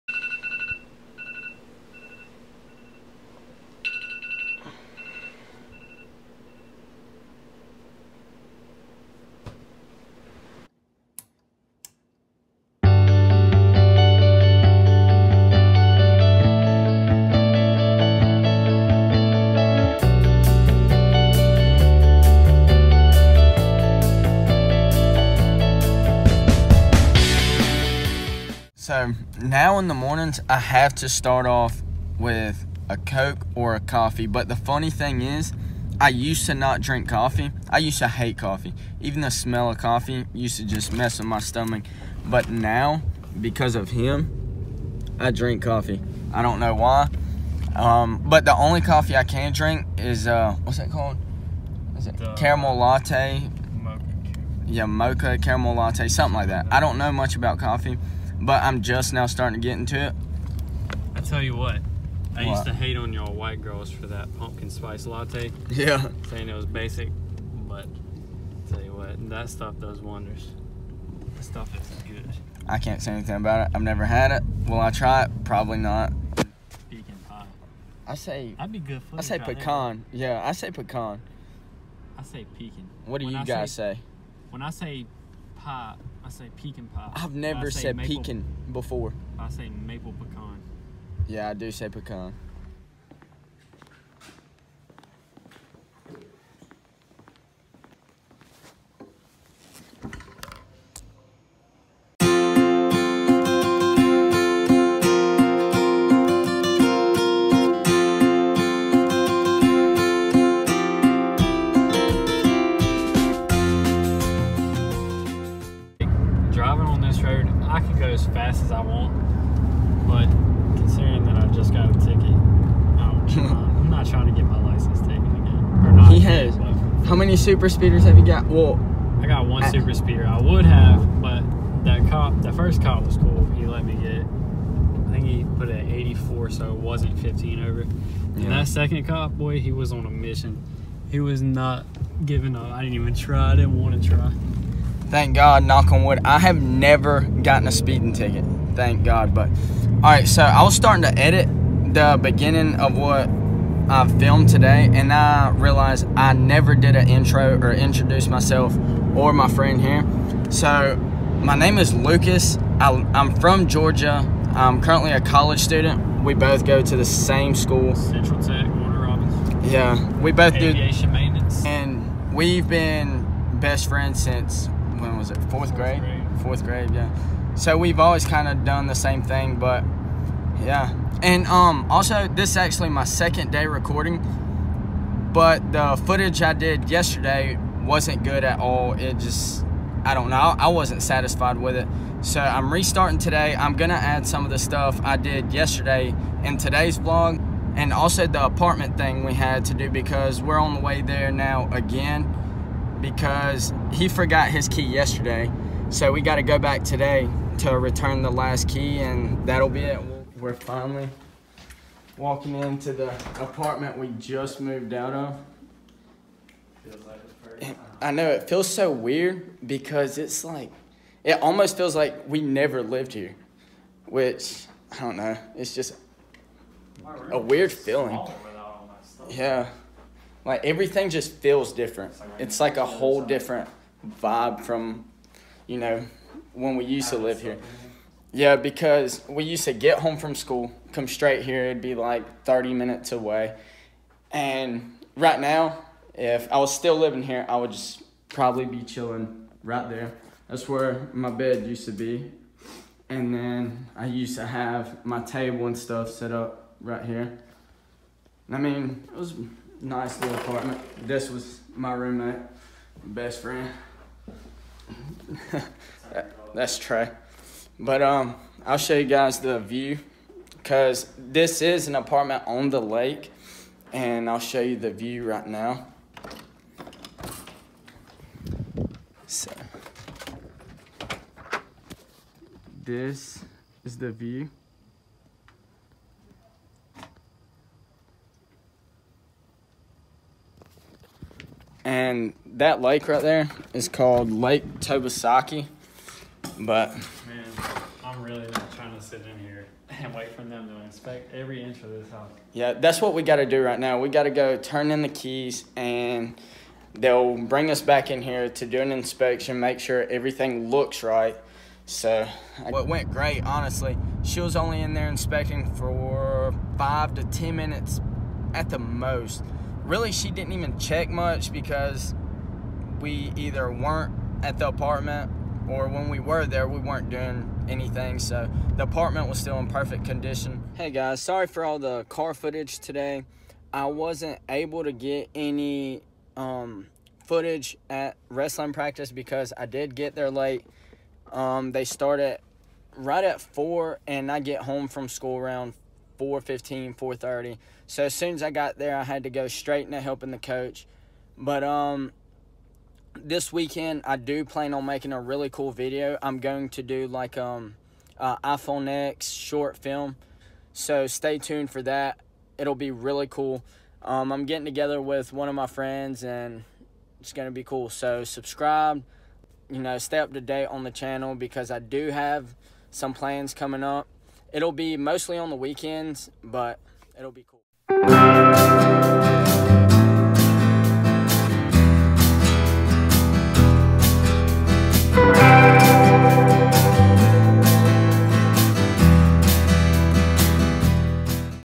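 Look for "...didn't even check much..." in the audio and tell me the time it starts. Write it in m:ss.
5:20.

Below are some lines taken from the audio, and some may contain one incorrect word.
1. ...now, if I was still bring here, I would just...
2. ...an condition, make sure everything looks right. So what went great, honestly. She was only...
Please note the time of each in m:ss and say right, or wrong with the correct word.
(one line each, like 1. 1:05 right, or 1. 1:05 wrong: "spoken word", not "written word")
1. 4:05 wrong: "living", not "bring"
2. 5:08 wrong: "inspection", not "condition".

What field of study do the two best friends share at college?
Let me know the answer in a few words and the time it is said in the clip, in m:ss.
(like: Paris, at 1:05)
Aviation maintenance, at 2:50.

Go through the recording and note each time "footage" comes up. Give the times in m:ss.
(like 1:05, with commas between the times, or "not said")
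3:06, 5:32, 5:37.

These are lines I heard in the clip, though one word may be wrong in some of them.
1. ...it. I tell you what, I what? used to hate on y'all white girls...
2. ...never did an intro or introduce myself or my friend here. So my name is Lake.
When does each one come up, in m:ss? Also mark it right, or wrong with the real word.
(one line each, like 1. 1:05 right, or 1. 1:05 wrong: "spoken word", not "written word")
1. 1:00 right
2. 2:36 wrong: "Lucas", not "Lake".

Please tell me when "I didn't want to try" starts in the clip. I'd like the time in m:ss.
2:23.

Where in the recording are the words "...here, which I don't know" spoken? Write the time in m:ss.
3:43.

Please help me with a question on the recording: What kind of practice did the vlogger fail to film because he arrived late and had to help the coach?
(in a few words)
wrestling.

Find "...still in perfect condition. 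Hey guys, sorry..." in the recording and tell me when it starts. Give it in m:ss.
5:29.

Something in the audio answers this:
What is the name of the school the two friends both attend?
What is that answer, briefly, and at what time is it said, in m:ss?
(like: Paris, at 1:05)
Central Tech, at 2:47.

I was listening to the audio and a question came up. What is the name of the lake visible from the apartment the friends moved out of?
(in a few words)
Lake Tobesofkee.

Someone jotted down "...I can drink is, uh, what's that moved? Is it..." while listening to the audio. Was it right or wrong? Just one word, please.
wrong.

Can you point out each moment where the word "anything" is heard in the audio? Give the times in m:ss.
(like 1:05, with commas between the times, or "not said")
1:13, 5:27.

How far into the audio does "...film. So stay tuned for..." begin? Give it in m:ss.
5:59.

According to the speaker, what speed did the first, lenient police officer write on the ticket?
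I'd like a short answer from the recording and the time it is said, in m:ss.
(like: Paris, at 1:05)
84, at 2:15.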